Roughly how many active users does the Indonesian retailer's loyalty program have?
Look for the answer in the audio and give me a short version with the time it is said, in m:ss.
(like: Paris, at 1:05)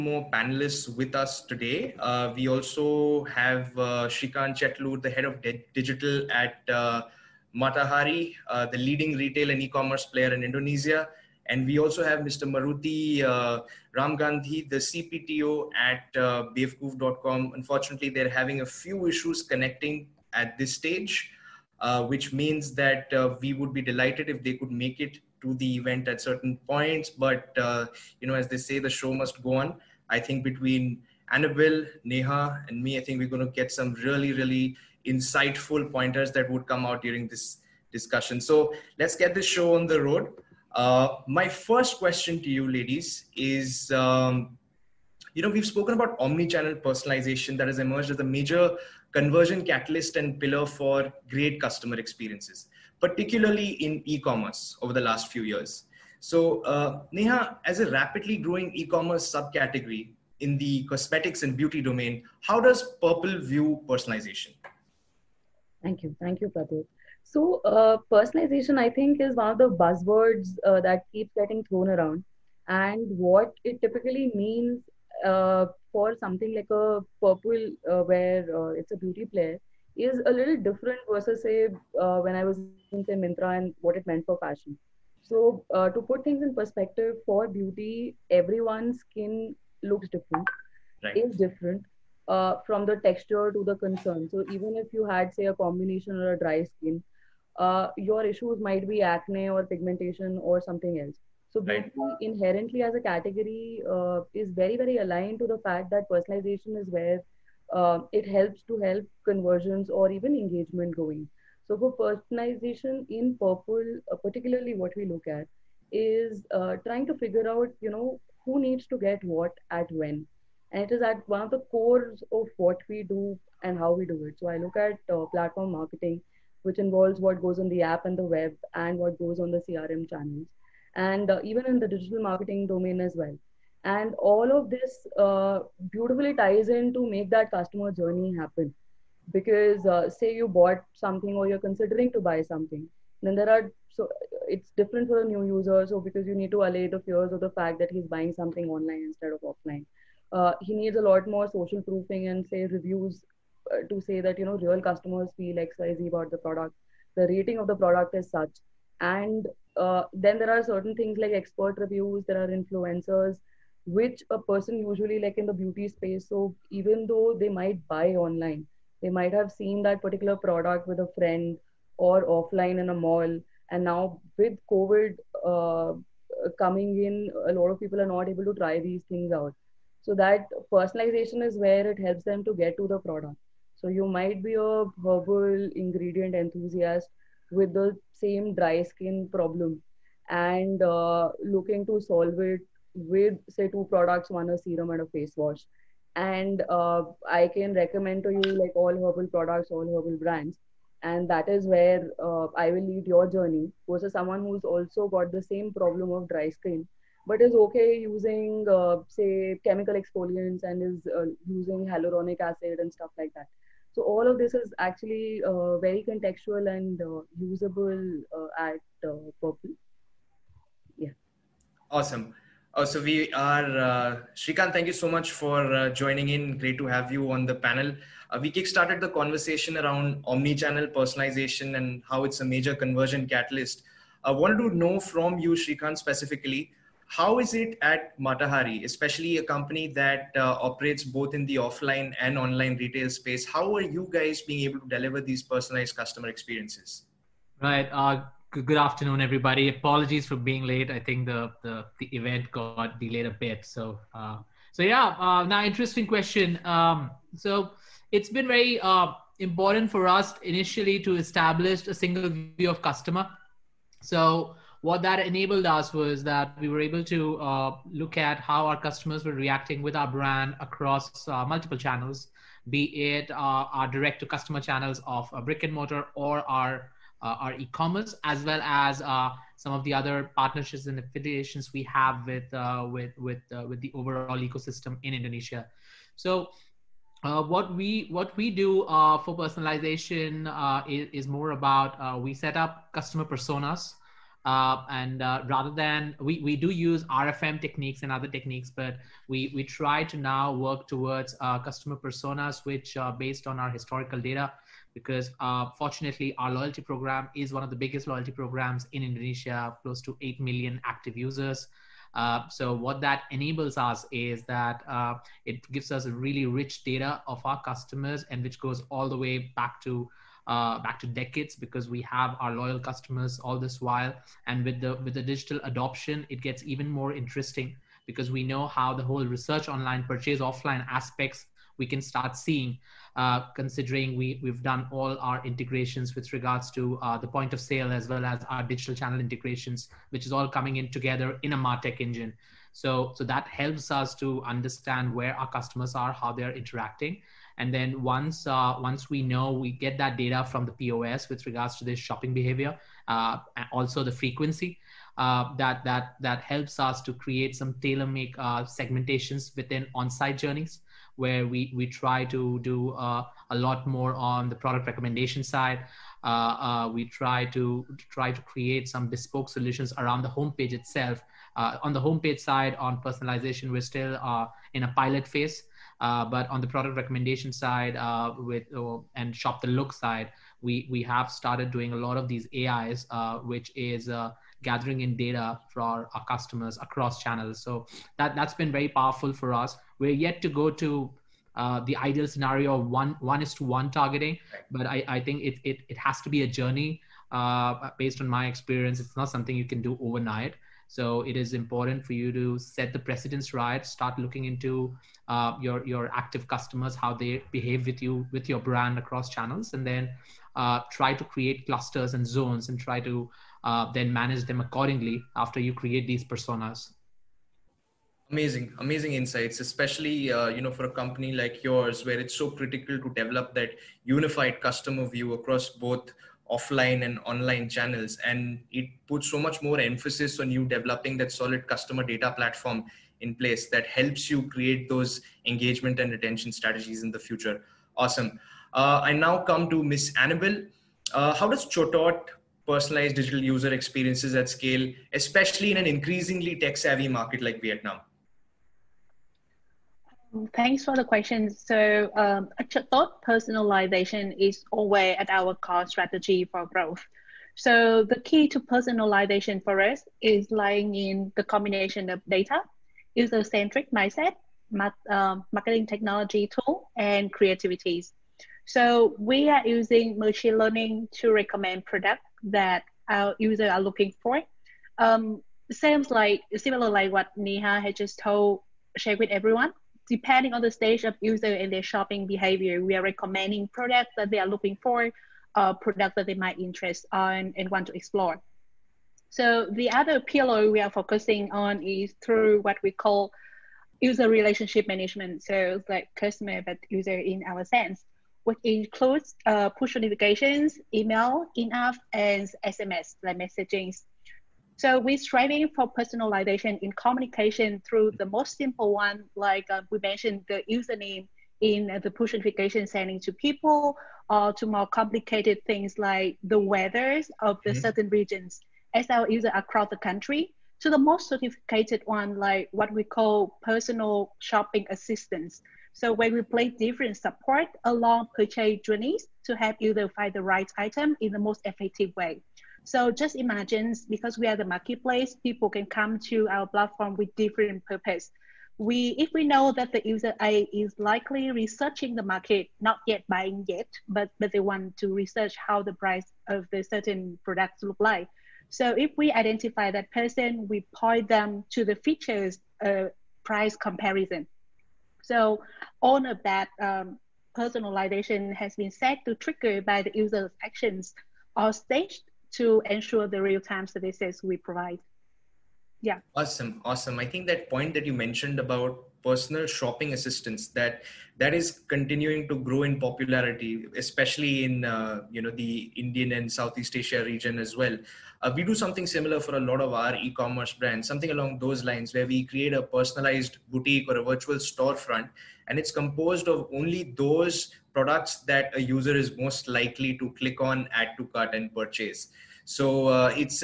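8 million, at 5:10.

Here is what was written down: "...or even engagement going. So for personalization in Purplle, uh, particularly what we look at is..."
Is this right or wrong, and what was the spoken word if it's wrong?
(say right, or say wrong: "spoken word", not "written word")
right.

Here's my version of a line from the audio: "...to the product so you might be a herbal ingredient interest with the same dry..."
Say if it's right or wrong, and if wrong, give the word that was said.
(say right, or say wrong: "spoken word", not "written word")
wrong: "enthusiast", not "interest".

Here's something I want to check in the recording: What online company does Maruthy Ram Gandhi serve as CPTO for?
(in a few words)
Bewakoof.com.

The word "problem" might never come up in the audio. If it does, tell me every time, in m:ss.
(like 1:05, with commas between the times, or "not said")
3:09, 3:25.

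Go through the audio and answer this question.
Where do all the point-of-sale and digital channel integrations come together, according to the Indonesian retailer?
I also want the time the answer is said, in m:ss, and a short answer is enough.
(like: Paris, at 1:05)
a Martech engine, at 5:41.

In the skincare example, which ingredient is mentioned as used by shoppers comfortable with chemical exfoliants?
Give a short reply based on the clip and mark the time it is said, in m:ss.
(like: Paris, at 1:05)
hyaluronic acid, at 3:31.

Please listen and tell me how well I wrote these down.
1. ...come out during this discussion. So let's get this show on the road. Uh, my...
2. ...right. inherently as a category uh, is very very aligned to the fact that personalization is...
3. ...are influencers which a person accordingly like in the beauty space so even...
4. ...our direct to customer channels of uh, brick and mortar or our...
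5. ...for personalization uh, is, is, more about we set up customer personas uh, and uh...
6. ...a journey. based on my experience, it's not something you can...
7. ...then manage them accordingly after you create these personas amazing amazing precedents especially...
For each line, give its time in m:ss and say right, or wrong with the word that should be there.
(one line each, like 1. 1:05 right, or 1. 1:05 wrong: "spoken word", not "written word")
1. 0:36 right
2. 1:41 right
3. 2:42 wrong: "usually", not "accordingly"
4. 4:33 right
5. 4:49 right
6. 6:36 right
7. 6:53 wrong: "insights", not "precedents".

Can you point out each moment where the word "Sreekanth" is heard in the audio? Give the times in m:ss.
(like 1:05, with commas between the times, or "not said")
0:04, 3:44, 3:55.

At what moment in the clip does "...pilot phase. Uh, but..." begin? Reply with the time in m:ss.
6:15.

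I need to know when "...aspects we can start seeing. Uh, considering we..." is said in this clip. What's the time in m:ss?
5:30.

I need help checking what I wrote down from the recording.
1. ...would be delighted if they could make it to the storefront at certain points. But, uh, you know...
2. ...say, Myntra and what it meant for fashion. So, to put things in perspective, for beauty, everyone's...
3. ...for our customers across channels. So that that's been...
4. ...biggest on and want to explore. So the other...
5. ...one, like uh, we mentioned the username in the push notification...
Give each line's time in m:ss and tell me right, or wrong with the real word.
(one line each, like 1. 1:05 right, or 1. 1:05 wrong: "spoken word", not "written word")
1. 0:23 wrong: "event", not "storefront"
2. 1:23 right
3. 6:25 right
4. 8:06 wrong: "interest", not "biggest"
5. 8:28 right.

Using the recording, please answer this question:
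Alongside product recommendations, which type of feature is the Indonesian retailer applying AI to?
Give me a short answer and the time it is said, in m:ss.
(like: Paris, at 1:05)
shop the look, at 6:19.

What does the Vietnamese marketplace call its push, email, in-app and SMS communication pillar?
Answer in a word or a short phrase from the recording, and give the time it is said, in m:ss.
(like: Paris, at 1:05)
user relationship management, at 8:14.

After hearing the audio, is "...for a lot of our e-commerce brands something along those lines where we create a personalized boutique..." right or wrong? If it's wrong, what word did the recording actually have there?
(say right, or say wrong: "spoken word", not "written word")
right.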